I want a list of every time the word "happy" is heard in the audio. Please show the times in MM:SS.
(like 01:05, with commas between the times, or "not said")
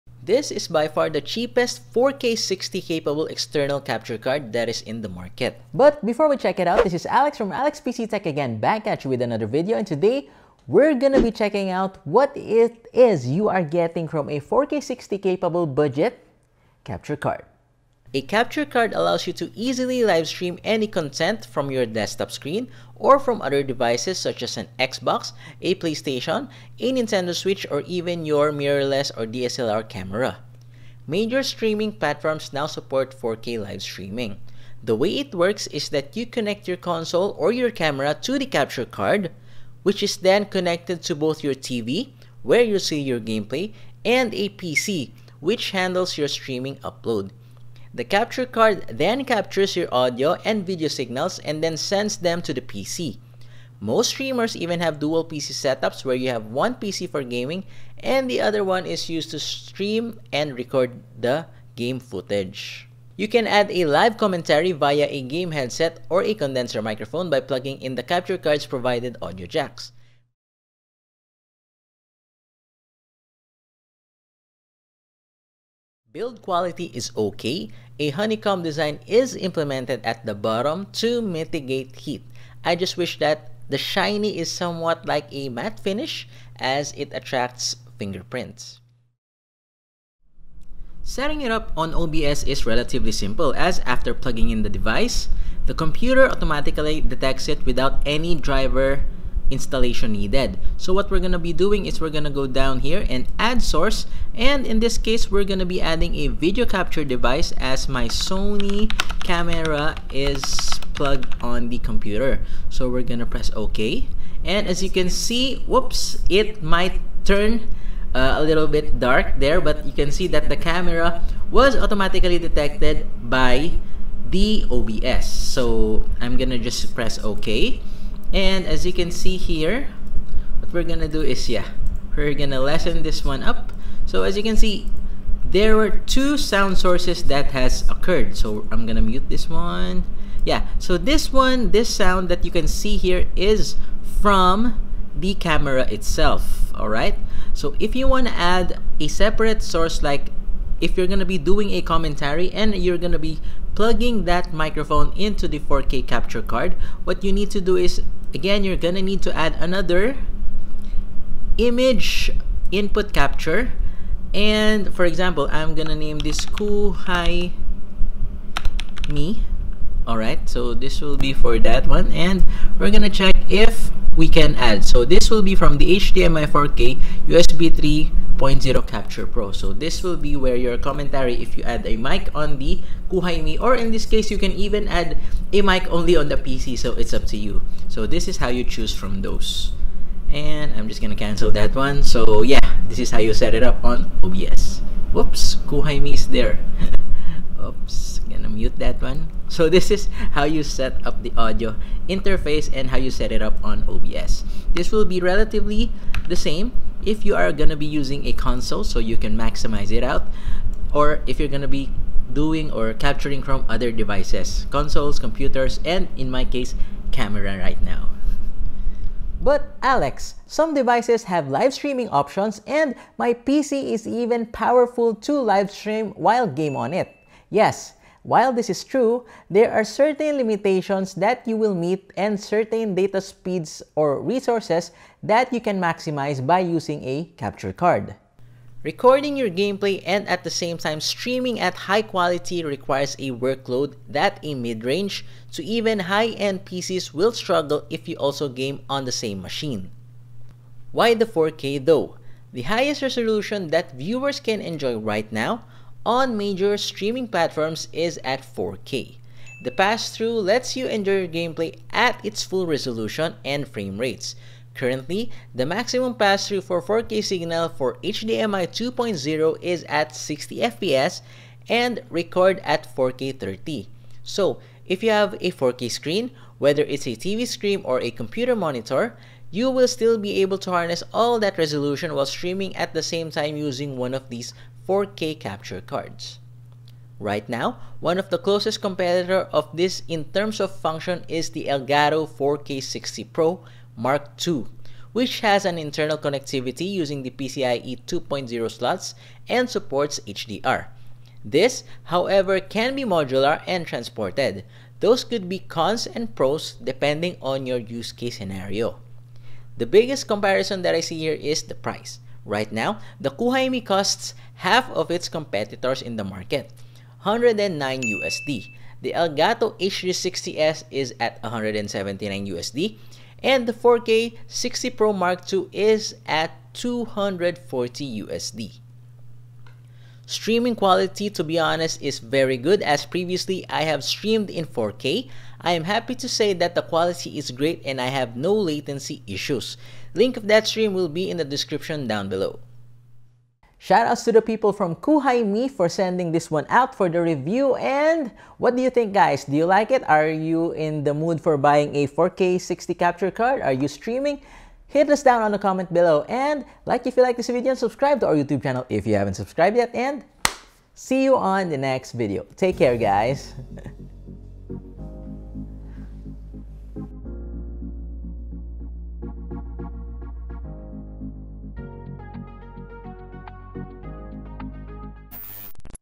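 05:35.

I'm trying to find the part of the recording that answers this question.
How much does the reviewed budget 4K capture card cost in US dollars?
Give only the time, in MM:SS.
05:17.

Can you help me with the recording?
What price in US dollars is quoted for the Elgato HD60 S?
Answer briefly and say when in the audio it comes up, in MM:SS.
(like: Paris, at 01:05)
179 USD, at 05:21.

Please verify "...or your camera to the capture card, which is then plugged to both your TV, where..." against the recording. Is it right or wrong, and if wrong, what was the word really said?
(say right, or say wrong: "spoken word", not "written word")
wrong: "connected", not "plugged".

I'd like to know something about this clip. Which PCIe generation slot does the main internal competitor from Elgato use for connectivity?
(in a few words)
PCIe 2.0.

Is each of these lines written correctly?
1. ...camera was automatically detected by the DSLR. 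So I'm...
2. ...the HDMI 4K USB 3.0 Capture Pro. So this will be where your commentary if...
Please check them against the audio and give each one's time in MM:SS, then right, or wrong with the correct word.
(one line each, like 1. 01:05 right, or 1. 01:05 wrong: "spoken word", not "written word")
1. 02:00 wrong: "OBS", not "DSLR"
2. 02:55 right.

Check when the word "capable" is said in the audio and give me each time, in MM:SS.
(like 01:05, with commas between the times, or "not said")
00:02, 00:15.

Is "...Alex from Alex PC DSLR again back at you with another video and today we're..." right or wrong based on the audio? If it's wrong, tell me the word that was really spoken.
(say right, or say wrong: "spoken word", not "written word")
wrong: "Tech", not "DSLR".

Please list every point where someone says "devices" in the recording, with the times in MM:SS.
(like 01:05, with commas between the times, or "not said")
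00:23, 01:34, 01:47, 03:33, 03:40.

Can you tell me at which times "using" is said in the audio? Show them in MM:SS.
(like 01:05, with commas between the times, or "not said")
03:27, 03:56, 04:43, 04:56.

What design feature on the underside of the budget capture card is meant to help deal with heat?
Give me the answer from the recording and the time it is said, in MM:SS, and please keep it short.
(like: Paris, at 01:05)
Honeycomb design, at 01:18.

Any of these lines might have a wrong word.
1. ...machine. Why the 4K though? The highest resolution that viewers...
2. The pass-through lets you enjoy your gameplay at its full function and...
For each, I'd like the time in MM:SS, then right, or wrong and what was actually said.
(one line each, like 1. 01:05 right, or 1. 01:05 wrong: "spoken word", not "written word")
1. 04:09 right
2. 04:19 wrong: "resolution", not "function".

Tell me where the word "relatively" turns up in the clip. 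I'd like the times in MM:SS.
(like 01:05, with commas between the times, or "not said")
01:32, 03:25.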